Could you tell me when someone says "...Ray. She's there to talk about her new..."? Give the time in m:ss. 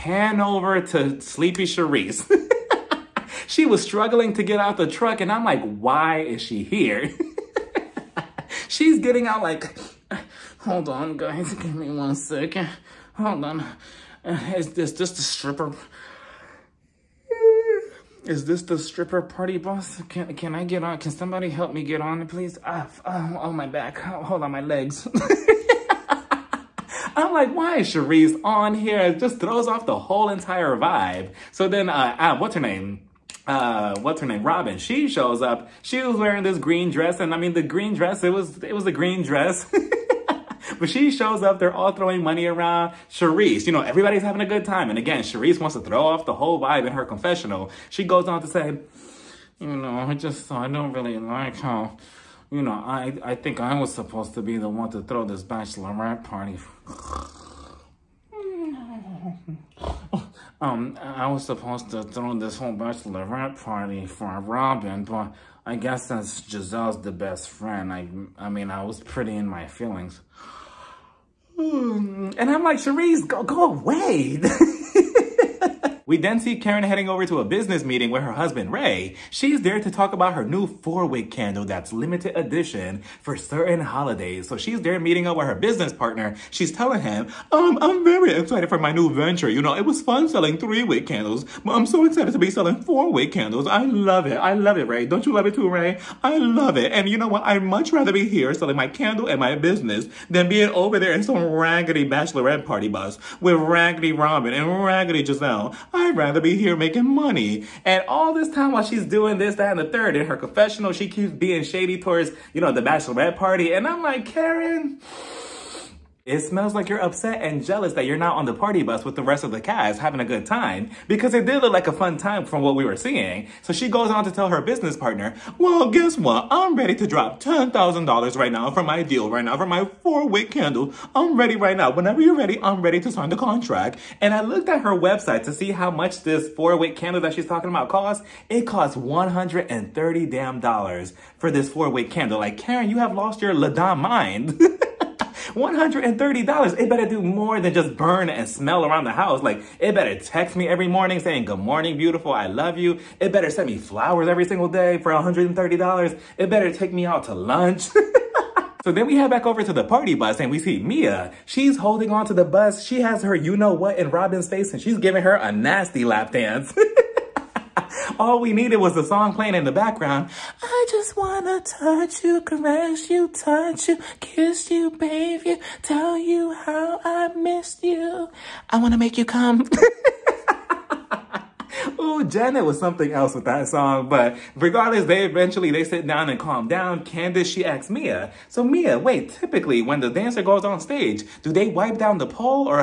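1:18.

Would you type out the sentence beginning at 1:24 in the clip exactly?
So she's there meeting up with her business partner.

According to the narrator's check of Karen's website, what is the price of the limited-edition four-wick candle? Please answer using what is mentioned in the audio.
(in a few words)
$130.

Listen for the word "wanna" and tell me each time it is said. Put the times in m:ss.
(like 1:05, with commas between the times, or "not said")
2:51, 2:58.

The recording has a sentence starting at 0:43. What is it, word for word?
Charisse, you know, everybody's having a good time.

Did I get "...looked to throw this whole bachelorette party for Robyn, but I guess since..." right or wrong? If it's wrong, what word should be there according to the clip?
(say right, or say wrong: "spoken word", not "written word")
wrong: "supposed", not "looked".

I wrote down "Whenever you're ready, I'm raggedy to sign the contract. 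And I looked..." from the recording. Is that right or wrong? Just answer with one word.
wrong.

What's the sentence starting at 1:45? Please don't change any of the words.
I'd rather be here making money.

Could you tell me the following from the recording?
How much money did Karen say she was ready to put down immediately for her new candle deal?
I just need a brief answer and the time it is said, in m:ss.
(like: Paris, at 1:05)
$10,000, at 2:07.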